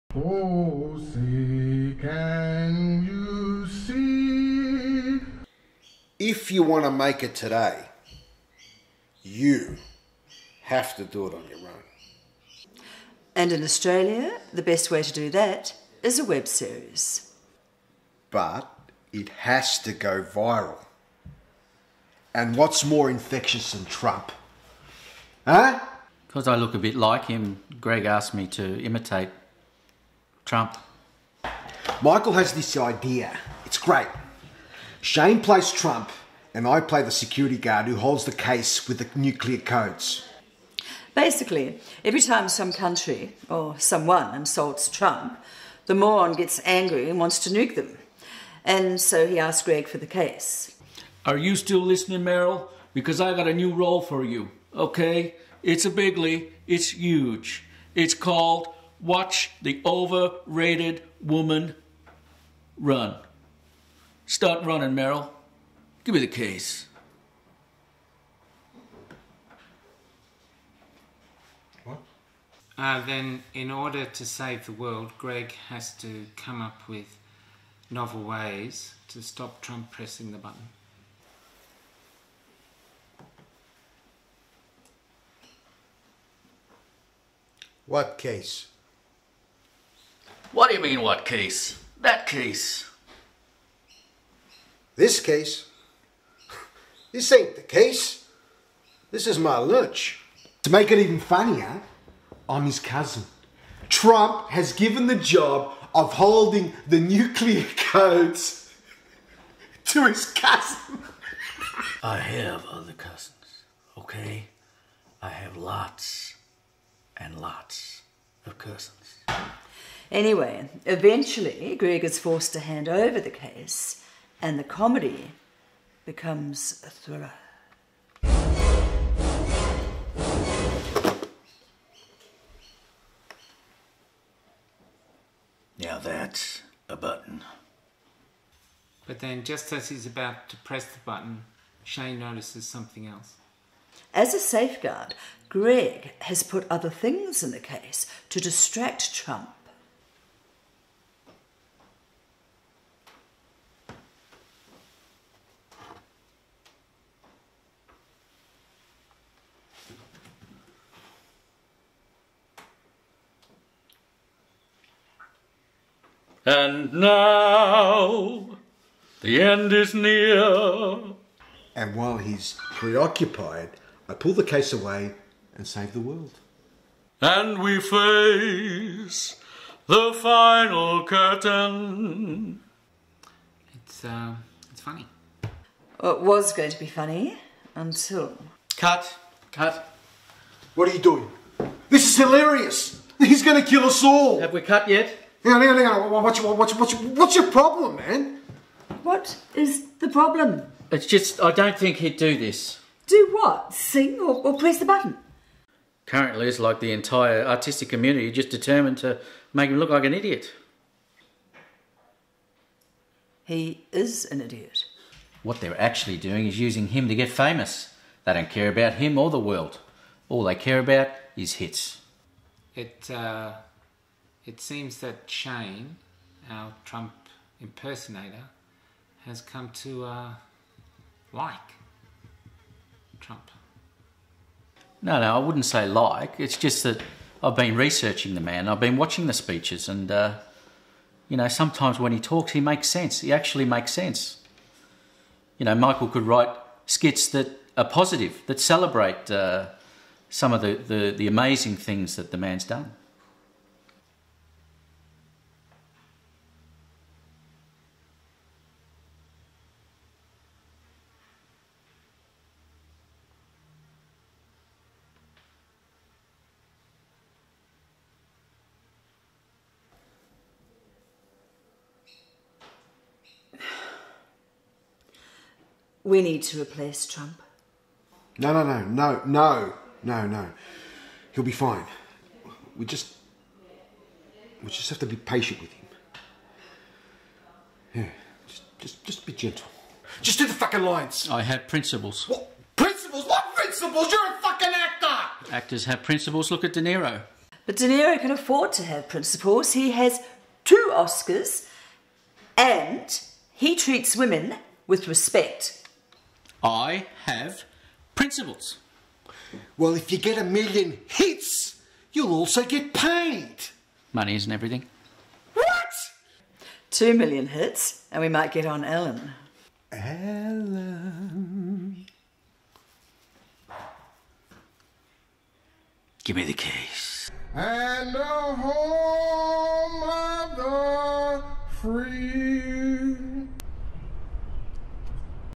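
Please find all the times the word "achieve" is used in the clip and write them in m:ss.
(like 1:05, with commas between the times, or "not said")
not said.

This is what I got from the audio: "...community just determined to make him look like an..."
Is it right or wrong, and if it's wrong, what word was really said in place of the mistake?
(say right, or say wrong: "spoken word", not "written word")
right.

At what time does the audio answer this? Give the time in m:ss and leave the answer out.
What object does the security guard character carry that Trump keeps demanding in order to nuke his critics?
0:38.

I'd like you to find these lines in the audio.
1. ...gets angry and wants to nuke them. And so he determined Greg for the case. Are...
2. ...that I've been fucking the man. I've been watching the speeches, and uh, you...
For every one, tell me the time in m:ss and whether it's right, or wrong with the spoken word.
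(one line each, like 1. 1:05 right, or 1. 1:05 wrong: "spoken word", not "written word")
1. 0:46 wrong: "asked", not "determined"
2. 3:56 wrong: "researching", not "fucking".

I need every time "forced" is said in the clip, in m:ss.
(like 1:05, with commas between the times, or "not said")
2:02.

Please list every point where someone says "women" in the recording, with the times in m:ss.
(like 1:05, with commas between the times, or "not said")
5:04.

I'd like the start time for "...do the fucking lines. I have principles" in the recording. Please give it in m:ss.
4:50.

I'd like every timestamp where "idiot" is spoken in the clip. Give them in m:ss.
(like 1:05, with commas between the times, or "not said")
3:30, 3:34.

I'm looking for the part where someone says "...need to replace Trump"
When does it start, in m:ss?
4:36.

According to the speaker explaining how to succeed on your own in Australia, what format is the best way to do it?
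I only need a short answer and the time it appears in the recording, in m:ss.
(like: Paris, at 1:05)
web series, at 0:16.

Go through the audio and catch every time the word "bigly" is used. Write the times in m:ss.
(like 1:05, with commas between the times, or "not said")
0:55.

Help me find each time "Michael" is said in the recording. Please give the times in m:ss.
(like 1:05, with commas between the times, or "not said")
0:32, 4:05.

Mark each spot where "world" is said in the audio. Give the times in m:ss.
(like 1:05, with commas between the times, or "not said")
1:14, 2:55, 3:39.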